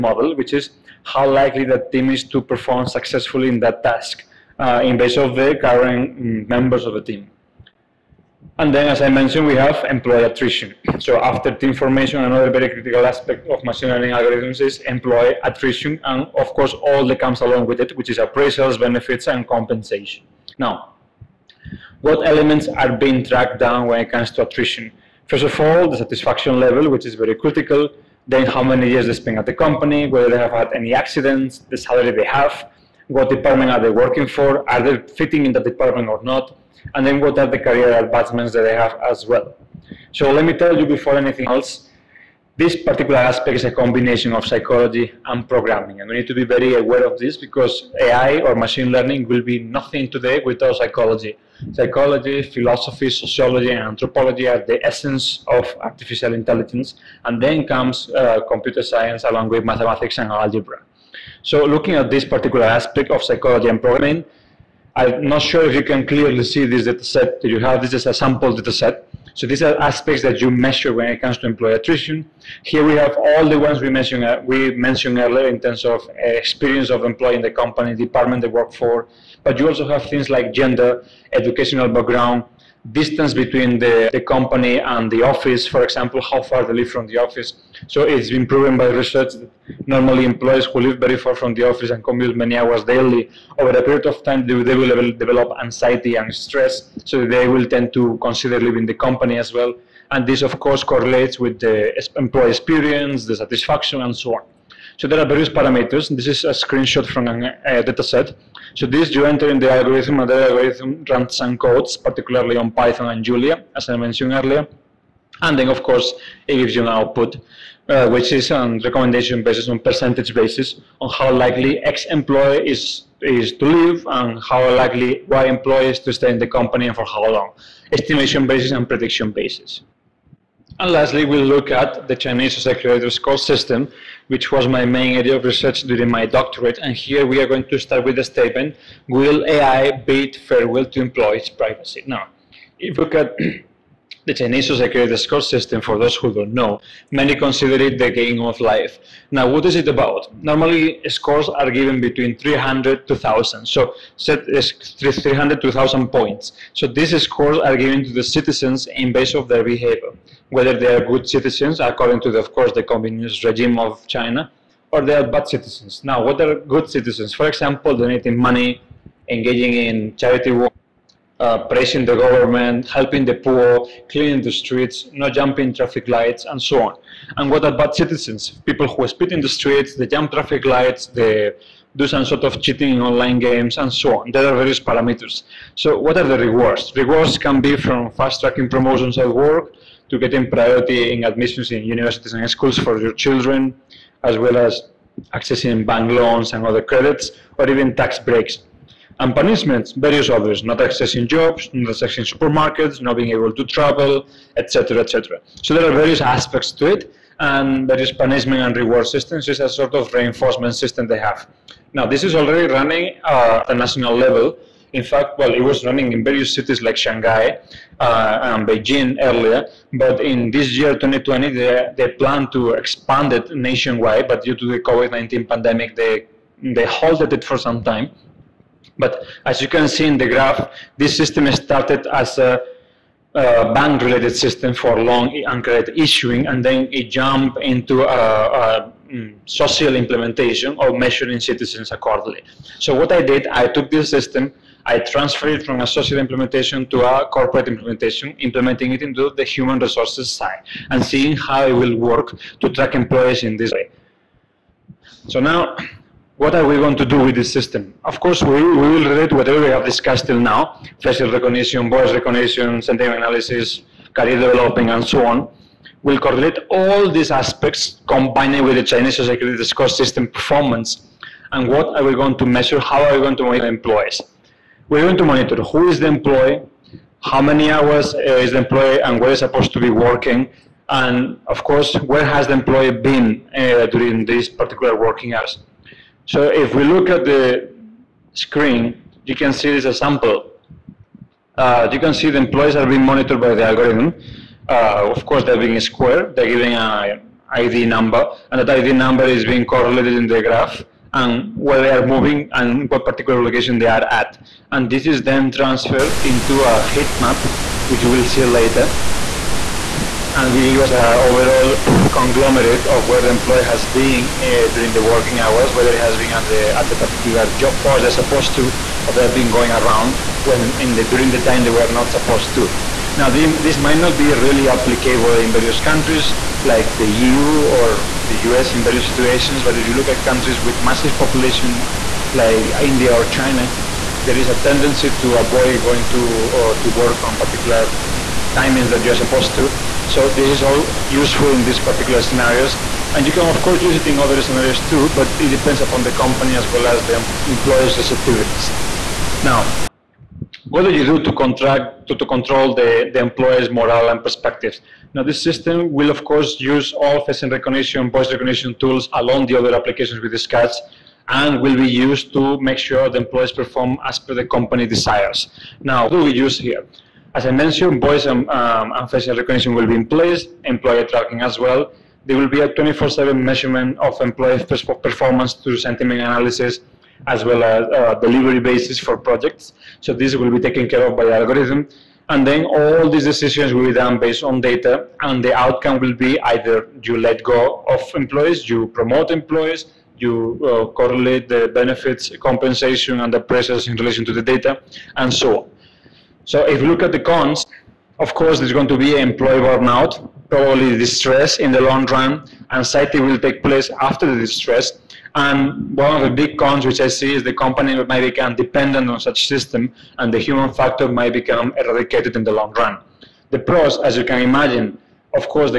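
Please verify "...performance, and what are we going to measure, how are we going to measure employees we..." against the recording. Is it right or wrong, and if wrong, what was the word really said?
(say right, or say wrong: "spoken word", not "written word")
right.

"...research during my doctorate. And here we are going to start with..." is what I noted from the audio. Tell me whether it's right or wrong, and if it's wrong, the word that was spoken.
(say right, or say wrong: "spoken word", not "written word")
right.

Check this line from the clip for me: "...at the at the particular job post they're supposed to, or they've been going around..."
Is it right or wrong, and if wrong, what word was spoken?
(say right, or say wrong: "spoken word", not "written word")
right.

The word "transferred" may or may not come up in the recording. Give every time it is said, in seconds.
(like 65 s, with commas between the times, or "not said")
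244 s, 305 s.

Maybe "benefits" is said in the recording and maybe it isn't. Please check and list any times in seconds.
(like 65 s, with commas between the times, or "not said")
18 s, 391 s.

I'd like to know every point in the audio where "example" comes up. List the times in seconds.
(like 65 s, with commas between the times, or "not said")
85 s, 167 s.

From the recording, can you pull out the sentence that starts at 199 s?
And punishments, various others, not accessing jobs, not accessing supermarkets, not being able to travel, etc., etc.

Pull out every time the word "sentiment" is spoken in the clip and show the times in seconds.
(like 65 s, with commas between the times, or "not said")
262 s, 375 s.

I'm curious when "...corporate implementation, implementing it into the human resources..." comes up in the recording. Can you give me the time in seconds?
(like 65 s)
247 s.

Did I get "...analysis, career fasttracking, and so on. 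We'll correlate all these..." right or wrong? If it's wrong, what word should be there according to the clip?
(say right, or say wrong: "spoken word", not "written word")
wrong: "developing", not "fasttracking".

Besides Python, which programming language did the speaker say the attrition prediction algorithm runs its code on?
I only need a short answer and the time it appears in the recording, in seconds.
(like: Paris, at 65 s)
Julia, at 113 s.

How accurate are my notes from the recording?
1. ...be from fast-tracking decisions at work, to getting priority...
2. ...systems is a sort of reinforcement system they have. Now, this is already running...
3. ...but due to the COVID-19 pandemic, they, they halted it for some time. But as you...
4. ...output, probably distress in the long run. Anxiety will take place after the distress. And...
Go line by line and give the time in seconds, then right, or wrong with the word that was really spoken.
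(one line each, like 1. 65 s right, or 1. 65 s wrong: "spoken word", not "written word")
1. 187 s wrong: "promotions", not "decisions"
2. 209 s right
3. 224 s right
4. 399 s wrong: "burnout", not "output".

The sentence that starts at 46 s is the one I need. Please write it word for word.
And we need to be very aware of this because AI or machine learning will be nothing today without psychology.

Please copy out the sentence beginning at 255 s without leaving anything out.
So now, what are we going to do with this system?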